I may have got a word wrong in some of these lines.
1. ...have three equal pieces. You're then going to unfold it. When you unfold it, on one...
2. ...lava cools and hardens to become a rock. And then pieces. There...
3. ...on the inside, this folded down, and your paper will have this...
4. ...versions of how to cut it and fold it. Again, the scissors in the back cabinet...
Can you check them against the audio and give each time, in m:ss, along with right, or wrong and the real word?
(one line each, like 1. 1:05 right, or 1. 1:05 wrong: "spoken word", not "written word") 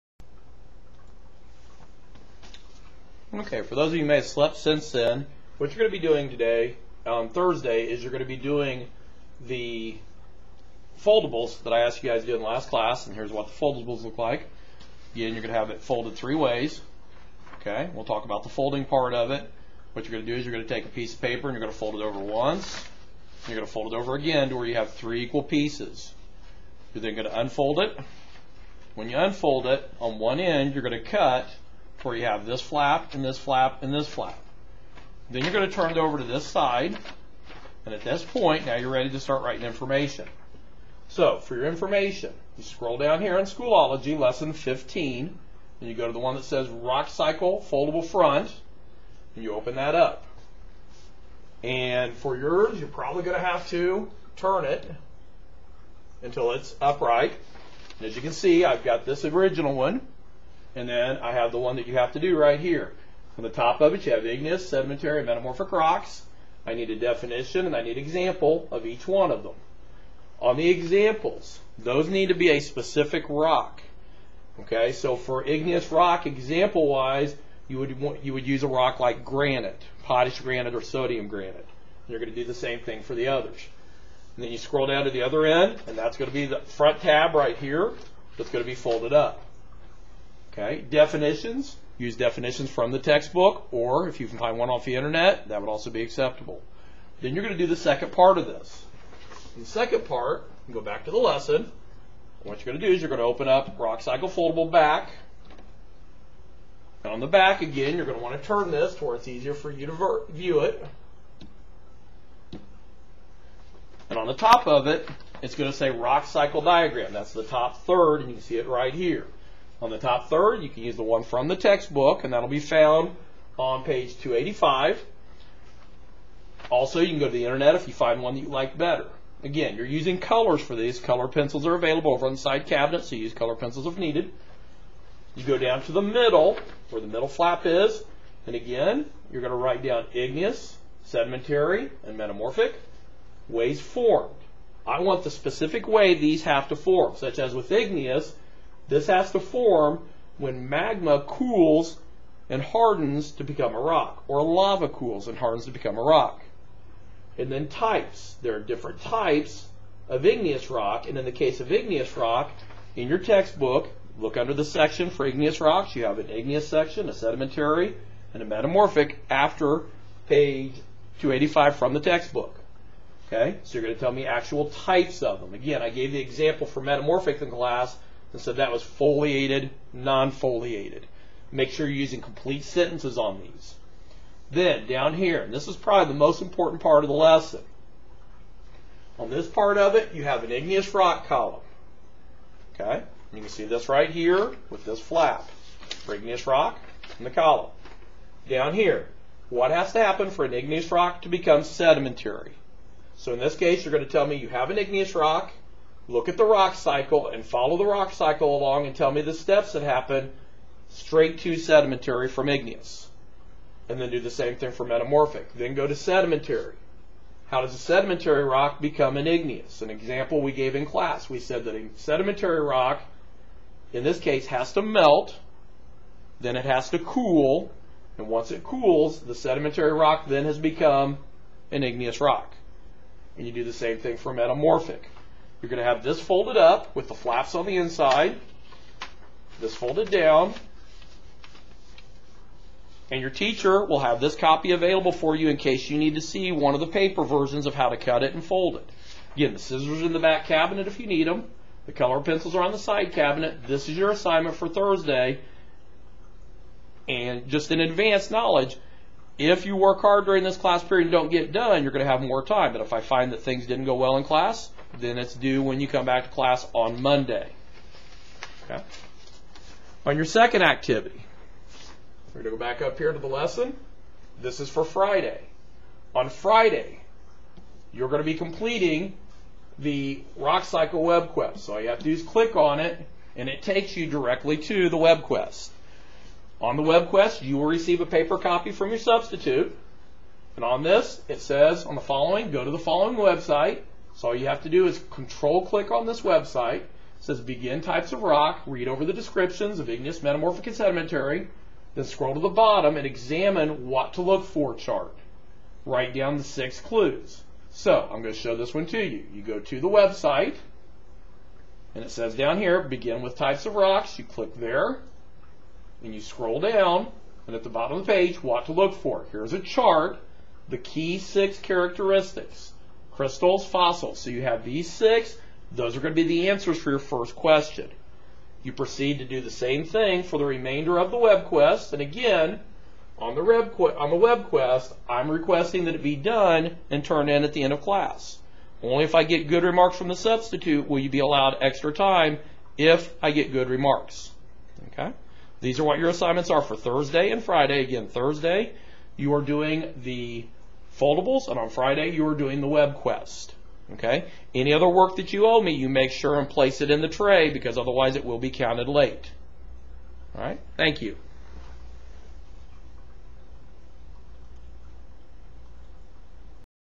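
1. 0:24 right
2. 2:34 wrong: "types", not "pieces"
3. 3:57 wrong: "teacher", not "paper"
4. 4:07 right.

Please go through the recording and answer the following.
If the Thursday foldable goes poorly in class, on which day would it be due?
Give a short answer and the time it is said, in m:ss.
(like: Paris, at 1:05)
Monday, at 4:27.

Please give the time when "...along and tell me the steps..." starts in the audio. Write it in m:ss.
3:28.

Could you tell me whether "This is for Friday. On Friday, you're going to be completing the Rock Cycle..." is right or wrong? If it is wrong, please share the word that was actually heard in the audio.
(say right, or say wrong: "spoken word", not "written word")
right.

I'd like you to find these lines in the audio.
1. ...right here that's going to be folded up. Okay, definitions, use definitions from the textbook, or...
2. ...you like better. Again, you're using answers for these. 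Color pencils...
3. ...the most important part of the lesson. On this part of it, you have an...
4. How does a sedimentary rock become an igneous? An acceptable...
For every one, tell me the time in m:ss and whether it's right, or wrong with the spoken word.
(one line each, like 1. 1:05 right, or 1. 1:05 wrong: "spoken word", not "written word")
1. 1:27 right
2. 2:08 wrong: "colors", not "answers"
3. 3:06 right
4. 3:37 wrong: "example", not "acceptable".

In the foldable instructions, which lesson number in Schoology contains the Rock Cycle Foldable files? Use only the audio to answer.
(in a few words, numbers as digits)
Lesson 15.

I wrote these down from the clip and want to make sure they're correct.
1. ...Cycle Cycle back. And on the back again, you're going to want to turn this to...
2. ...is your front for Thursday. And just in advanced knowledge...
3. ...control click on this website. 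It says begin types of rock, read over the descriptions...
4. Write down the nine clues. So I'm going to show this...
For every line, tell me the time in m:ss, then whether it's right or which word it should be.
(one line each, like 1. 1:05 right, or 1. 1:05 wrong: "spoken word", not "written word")
1. 1:44 wrong: "Foldable", not "Cycle"
2. 4:13 wrong: "assignment", not "front"
3. 4:55 right
4. 5:05 wrong: "six", not "nine".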